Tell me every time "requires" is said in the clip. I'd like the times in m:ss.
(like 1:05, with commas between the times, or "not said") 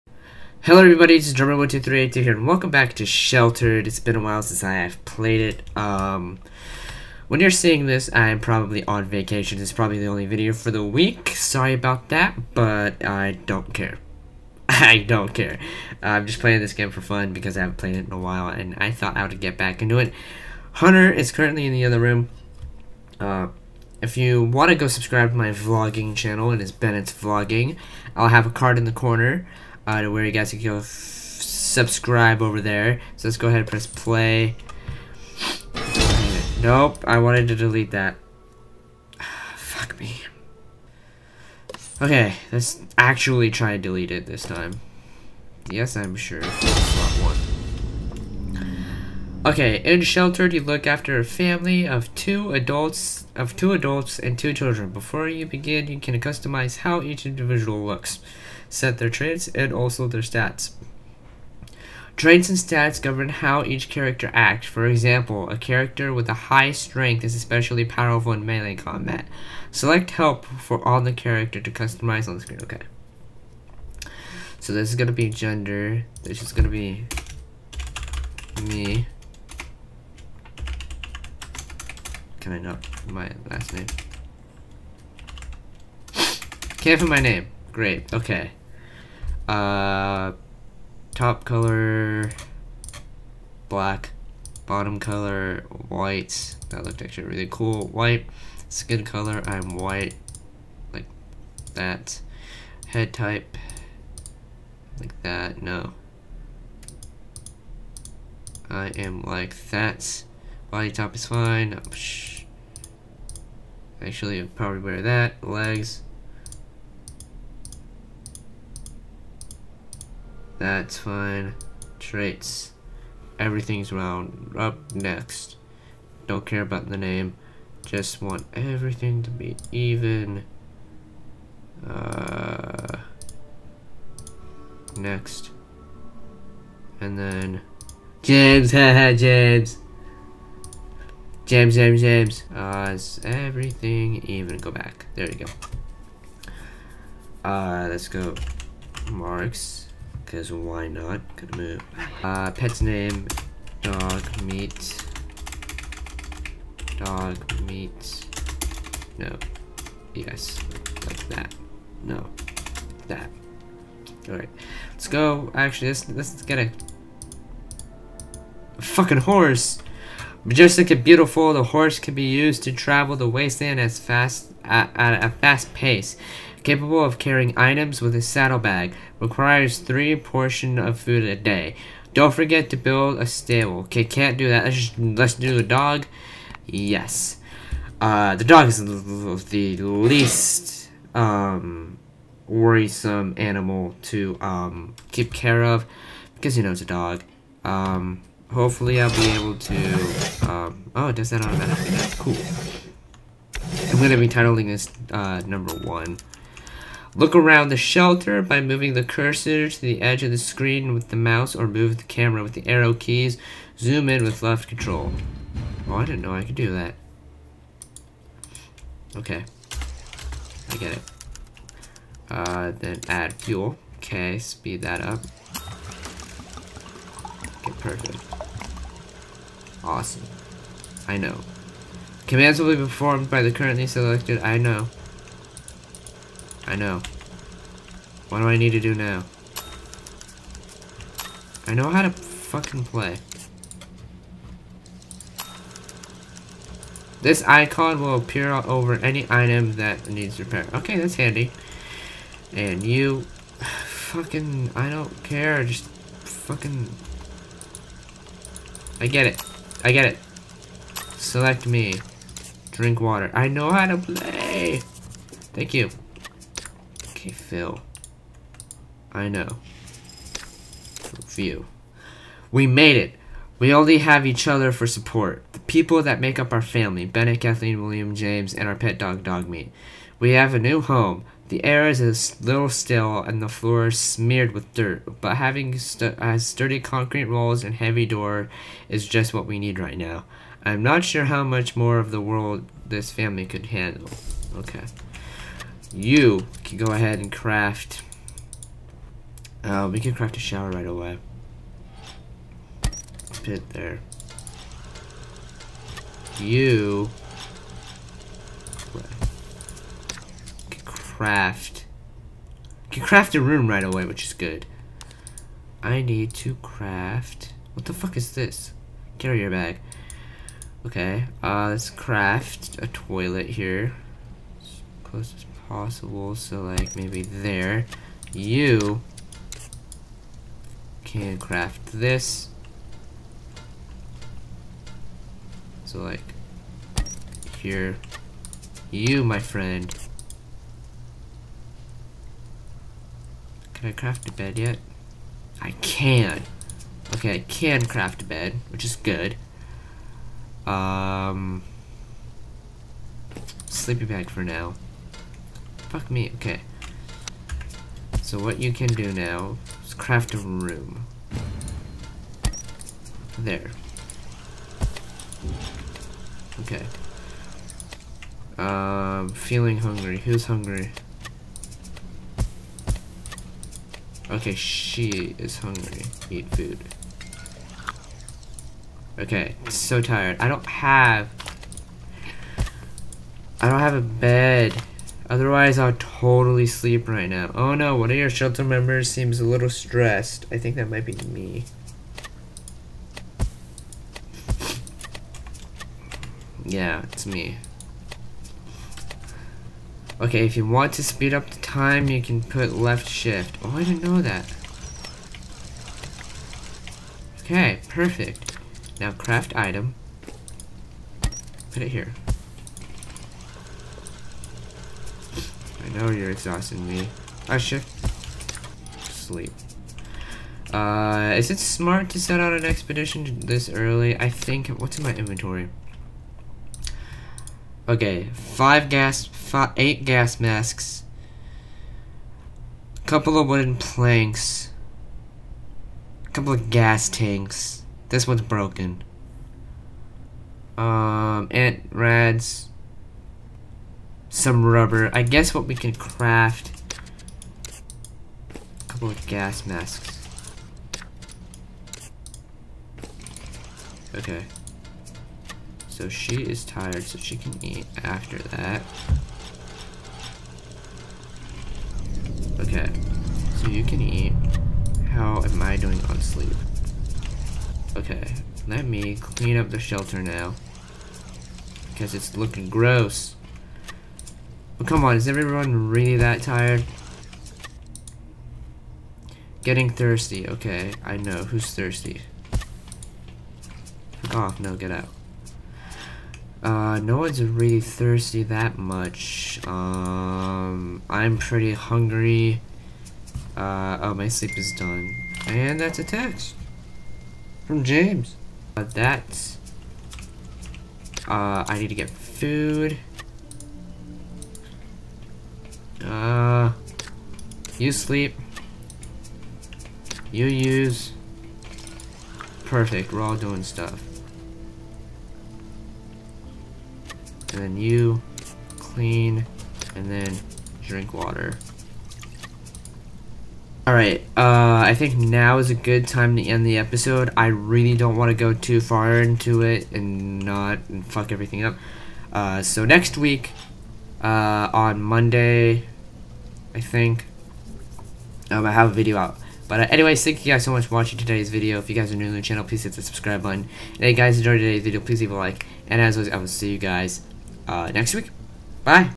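2:59.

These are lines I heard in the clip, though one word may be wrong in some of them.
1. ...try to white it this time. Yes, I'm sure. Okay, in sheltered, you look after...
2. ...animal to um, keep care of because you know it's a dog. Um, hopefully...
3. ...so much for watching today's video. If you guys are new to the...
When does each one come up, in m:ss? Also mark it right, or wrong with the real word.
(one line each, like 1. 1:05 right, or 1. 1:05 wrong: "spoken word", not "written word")
1. 0:43 wrong: "delete", not "white"
2. 3:13 right
3. 9:00 right.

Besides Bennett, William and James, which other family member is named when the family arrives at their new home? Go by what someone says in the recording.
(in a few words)
Kathleen.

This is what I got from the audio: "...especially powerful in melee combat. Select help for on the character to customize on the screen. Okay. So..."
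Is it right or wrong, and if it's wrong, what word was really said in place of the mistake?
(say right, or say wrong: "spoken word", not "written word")
right.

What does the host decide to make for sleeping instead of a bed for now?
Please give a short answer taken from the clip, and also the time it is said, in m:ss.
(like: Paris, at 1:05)
Sleeping bag, at 5:53.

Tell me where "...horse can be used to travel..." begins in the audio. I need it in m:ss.
2:51.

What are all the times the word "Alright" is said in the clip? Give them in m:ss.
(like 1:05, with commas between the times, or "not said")
2:44, 8:43.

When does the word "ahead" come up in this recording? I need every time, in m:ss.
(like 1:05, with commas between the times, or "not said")
0:33, 4:56.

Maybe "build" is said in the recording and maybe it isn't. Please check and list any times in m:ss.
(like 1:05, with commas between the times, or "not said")
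3:02.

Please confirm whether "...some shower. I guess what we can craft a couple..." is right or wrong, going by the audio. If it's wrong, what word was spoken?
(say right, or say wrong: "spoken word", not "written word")
wrong: "rubber", not "shower".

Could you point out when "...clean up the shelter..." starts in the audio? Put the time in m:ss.
7:49.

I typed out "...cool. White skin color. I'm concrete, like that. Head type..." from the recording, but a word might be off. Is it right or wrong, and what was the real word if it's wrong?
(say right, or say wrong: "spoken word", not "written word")
wrong: "white", not "concrete".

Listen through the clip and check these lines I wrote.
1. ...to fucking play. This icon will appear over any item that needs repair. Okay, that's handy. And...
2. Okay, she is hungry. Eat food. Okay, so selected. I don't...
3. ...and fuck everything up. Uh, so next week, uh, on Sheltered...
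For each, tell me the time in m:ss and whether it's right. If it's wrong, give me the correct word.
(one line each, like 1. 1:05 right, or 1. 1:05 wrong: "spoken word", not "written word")
1. 4:02 right
2. 6:14 wrong: "tired", not "selected"
3. 8:50 wrong: "Monday", not "Sheltered".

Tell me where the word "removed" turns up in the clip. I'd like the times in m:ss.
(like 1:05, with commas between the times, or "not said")
not said.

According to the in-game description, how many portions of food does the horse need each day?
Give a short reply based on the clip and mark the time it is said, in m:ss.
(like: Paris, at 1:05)
3, at 2:59.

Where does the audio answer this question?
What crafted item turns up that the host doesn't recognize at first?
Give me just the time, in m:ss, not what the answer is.
5:19.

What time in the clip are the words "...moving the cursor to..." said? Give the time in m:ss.
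3:28.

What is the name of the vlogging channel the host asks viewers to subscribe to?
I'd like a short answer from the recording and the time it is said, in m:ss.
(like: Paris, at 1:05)
Bennett's Vlogging, at 0:26.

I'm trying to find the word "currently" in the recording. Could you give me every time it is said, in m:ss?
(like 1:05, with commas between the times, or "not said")
0:21, 3:53.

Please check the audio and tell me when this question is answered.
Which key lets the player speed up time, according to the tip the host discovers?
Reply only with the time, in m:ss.
6:42.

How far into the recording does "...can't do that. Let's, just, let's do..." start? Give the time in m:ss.
3:04.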